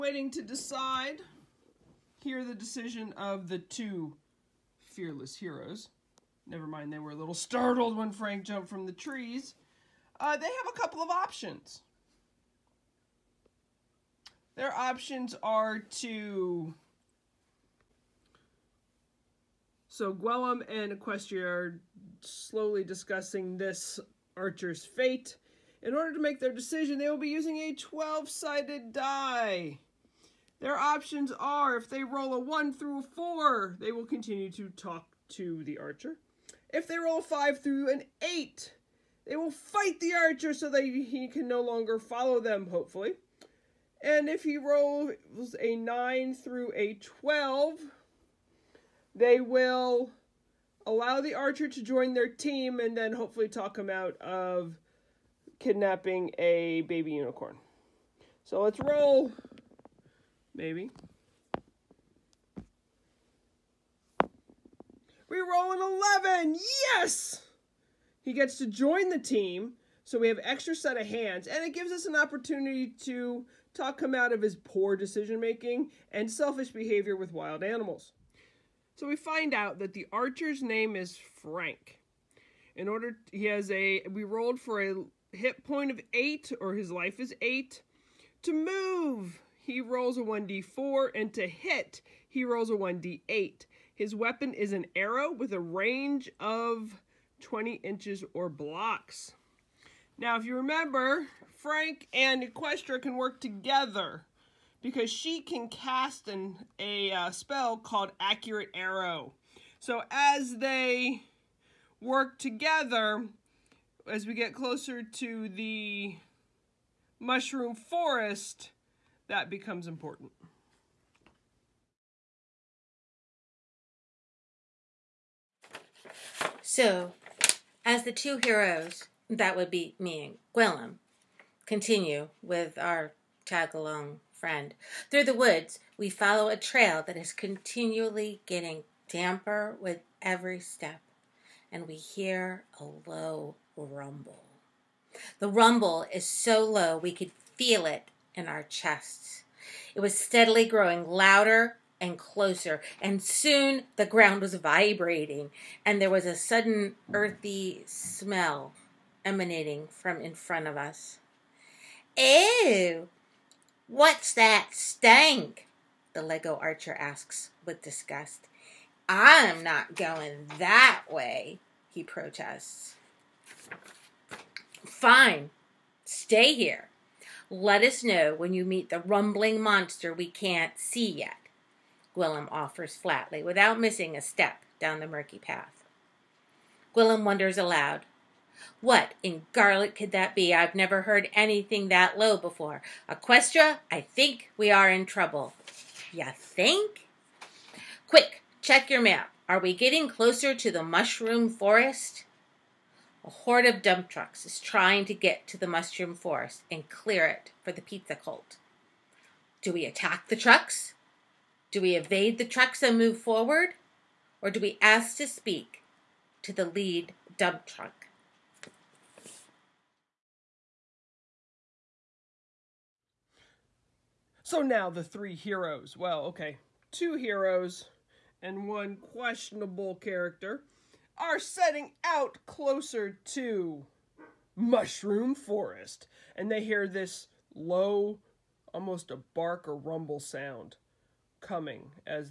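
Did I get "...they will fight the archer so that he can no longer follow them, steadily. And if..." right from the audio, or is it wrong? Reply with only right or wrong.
wrong.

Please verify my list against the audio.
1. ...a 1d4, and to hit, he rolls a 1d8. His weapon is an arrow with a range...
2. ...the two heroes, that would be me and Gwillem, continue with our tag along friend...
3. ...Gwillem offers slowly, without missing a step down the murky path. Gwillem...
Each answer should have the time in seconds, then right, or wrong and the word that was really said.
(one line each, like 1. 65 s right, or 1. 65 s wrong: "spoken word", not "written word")
1. 90 s right
2. 128 s right
3. 182 s wrong: "flatly", not "slowly".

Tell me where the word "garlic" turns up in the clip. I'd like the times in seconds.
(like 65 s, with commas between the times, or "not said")
189 s.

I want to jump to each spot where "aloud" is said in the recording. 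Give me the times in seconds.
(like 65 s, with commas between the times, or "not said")
187 s.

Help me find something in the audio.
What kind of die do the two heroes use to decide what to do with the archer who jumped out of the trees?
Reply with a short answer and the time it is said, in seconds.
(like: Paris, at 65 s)
12-sided die, at 27 s.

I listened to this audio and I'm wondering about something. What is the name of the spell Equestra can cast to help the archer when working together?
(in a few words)
Accurate Arrow.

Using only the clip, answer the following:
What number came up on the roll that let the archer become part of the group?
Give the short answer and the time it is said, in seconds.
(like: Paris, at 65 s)
11, at 66 s.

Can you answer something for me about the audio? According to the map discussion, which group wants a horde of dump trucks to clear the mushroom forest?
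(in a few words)
the pizza cult.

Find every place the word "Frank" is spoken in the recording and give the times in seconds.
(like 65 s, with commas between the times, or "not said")
8 s, 81 s, 101 s.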